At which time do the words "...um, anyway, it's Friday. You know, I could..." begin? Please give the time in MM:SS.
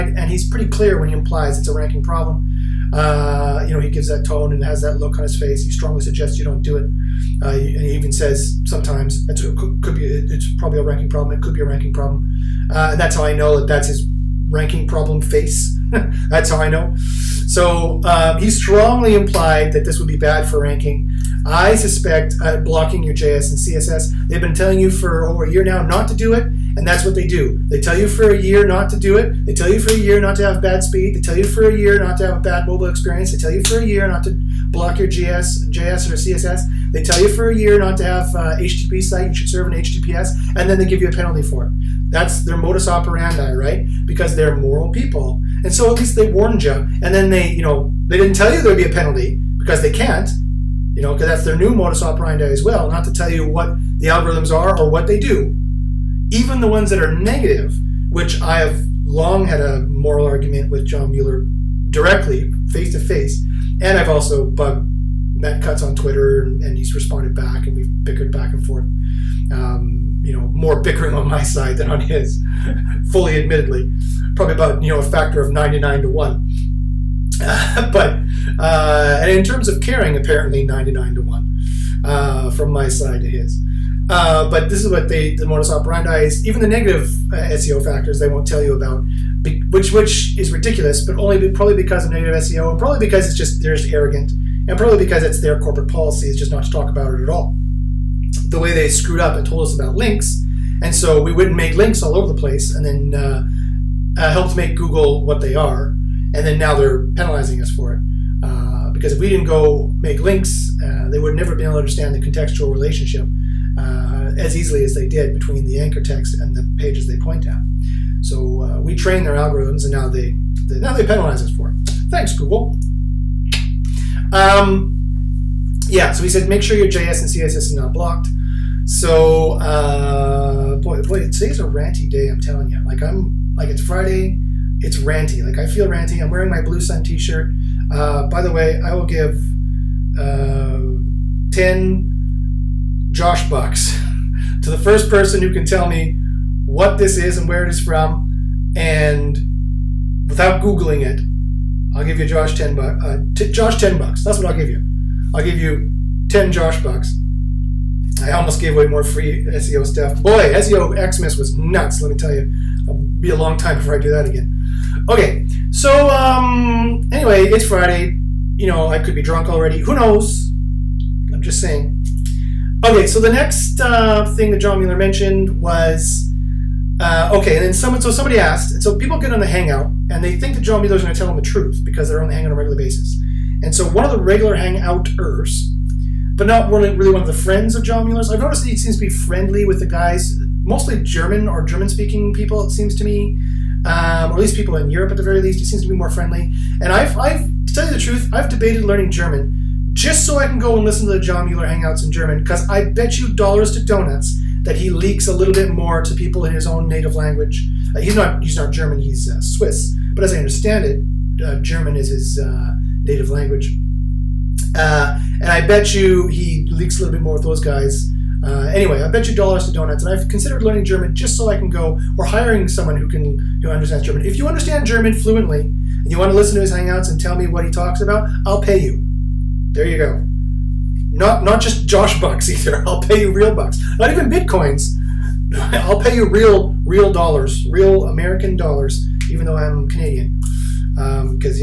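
02:46.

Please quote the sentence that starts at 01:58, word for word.
So uh, we train their algorithms, and now they, they, now they penalize us for it.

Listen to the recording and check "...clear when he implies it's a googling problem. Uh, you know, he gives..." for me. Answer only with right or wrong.
wrong.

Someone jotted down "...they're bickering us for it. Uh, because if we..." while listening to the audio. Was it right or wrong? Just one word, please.
wrong.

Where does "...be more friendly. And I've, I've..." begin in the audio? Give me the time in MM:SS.
03:15.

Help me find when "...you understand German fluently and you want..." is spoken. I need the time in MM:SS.
03:44.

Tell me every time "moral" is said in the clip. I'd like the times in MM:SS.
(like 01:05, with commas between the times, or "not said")
00:44, 00:59.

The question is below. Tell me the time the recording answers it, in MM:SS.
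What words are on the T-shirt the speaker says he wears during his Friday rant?
02:16.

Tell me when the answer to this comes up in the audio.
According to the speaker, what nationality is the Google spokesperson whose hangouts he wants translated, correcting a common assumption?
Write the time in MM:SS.
03:29.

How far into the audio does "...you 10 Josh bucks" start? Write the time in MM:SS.
02:35.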